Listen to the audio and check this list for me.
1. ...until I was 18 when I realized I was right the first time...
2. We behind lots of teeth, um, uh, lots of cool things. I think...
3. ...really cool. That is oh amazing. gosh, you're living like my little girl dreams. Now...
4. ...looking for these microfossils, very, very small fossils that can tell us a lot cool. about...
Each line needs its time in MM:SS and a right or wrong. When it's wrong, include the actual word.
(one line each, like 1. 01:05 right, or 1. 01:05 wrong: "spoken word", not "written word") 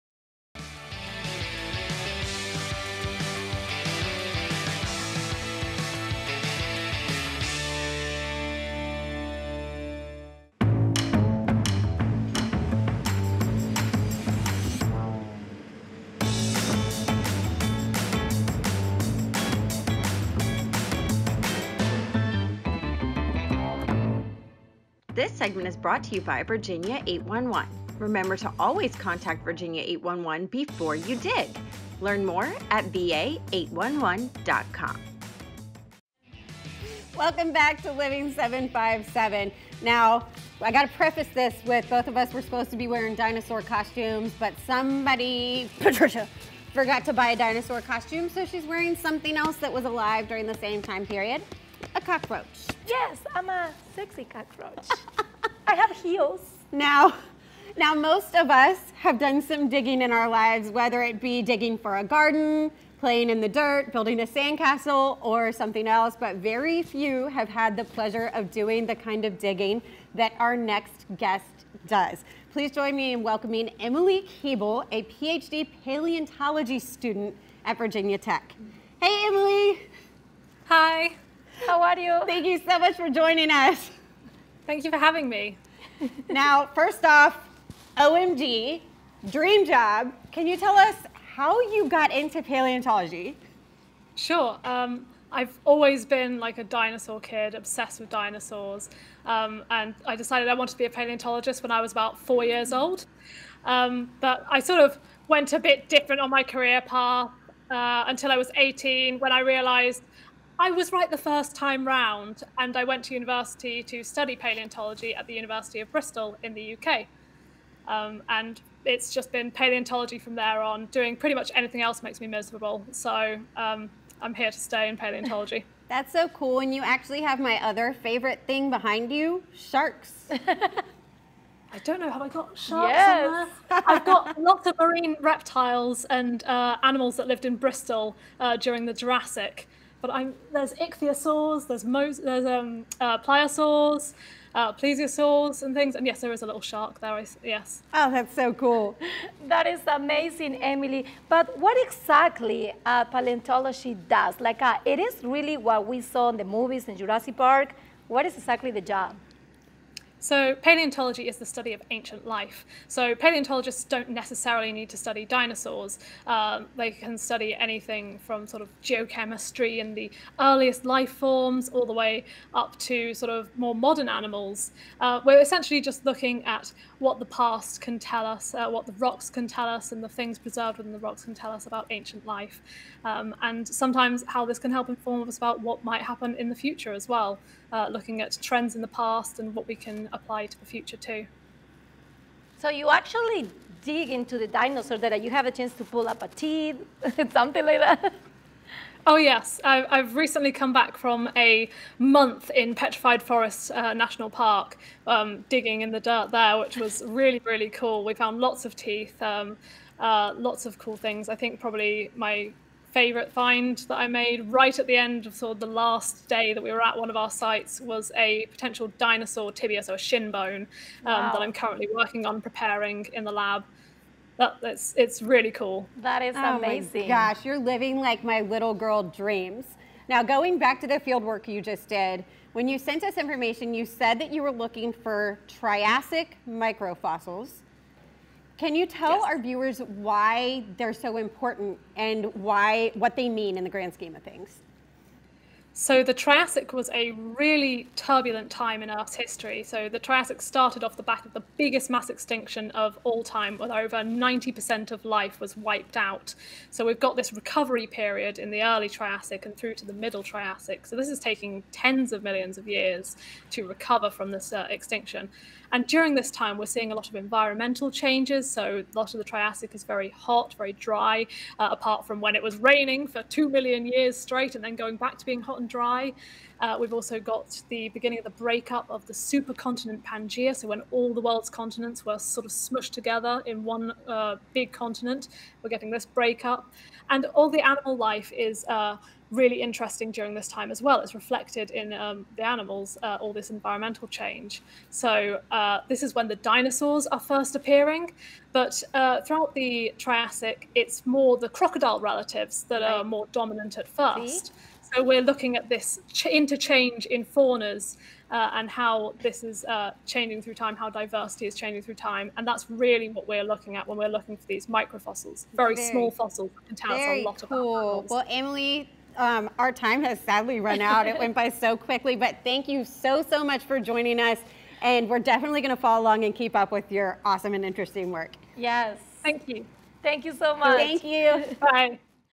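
1. 01:48 right
2. 03:28 wrong: "found", not "behind"
3. 03:45 right
4. 05:14 right.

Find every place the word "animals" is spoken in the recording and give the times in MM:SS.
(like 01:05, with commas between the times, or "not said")
02:16, 02:54, 04:47, 04:52, 05:17.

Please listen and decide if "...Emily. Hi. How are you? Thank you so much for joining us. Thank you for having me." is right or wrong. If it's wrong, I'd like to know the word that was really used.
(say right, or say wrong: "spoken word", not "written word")
right.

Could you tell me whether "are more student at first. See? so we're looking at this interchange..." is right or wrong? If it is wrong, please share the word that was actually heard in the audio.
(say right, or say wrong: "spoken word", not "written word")
wrong: "dominant", not "student".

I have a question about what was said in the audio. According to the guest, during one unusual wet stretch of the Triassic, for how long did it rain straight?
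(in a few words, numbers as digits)
2 million years.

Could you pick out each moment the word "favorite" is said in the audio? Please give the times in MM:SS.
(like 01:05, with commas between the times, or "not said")
02:08, 03:32.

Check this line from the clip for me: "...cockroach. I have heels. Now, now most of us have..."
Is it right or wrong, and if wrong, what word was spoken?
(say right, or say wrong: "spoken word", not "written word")
right.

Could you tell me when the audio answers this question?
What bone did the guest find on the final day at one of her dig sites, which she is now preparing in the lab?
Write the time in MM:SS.
03:38.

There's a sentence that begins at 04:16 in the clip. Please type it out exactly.
So we've got this recovery period in the early Triassic and through to the middle Triassic.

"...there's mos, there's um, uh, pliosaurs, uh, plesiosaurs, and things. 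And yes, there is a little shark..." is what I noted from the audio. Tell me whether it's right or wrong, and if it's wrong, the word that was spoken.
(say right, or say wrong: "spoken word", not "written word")
right.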